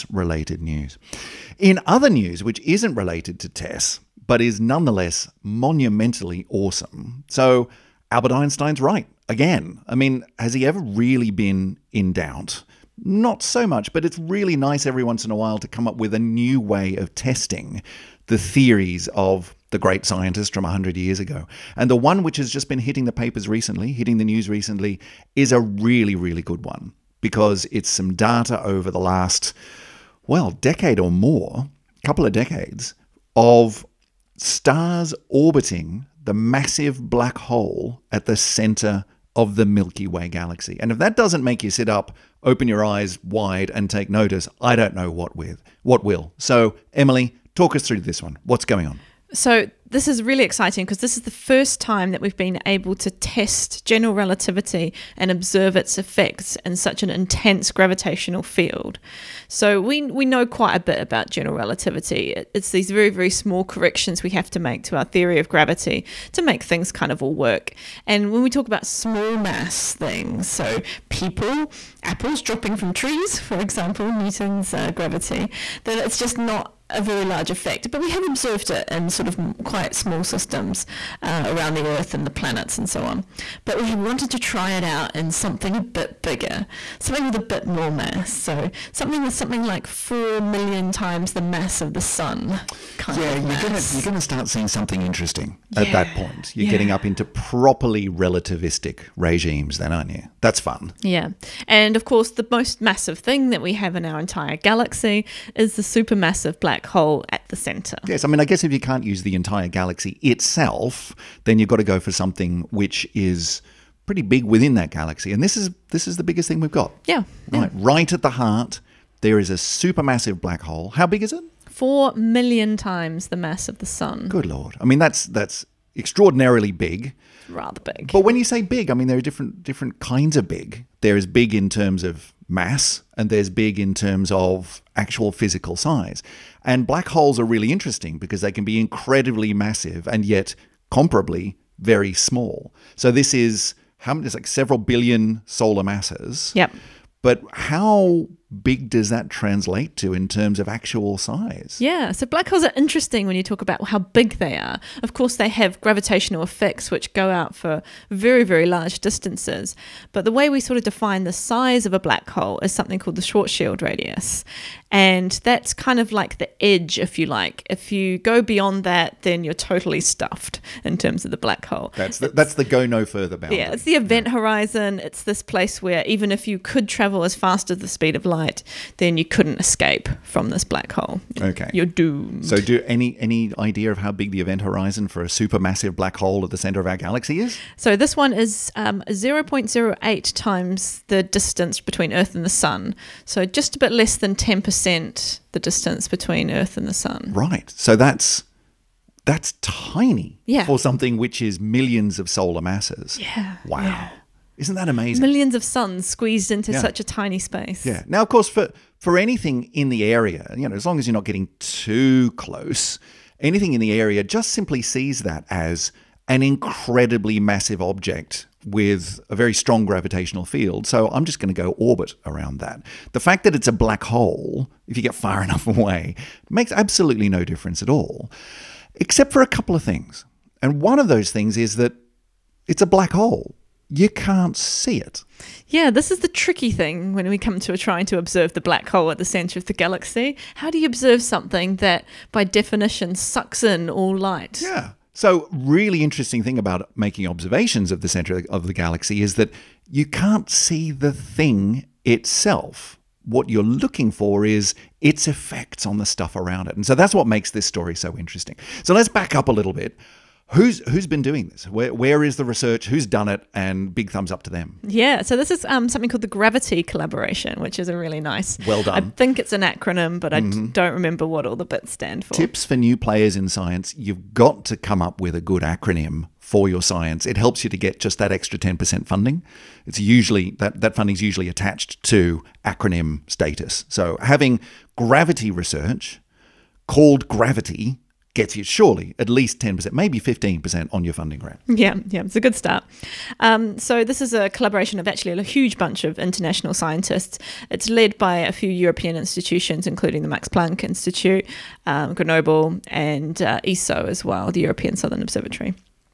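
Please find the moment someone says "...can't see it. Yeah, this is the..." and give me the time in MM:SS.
03:54.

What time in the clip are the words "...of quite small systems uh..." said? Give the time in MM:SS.
01:19.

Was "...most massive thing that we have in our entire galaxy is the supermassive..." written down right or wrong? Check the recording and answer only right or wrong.
right.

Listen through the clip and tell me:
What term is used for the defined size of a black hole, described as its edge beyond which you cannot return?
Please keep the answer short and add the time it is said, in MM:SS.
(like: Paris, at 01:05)
Schwarzschild radius, at 02:43.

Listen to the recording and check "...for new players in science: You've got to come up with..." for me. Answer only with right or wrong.
right.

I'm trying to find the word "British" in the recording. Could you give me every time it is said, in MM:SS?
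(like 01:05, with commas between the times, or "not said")
not said.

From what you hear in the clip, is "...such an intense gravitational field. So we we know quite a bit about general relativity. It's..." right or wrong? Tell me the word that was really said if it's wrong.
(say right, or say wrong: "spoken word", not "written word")
right.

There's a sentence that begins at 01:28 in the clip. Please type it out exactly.
So something with something like four million times the mass of the sun.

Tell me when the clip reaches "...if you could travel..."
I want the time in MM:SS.
02:56.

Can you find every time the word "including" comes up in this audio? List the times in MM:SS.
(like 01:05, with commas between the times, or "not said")
04:59.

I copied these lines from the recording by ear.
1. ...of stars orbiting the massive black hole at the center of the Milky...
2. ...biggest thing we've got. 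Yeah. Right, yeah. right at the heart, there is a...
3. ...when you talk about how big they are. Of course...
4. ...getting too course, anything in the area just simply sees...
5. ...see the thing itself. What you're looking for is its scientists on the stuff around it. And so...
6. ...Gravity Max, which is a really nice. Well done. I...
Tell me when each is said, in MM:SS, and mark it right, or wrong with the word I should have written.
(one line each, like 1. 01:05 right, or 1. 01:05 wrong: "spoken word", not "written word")
1. 00:33 right
2. 01:56 right
3. 02:33 right
4. 03:31 wrong: "close", not "course"
5. 04:10 wrong: "effects", not "scientists"
6. 04:26 wrong: "Collaboration", not "Max".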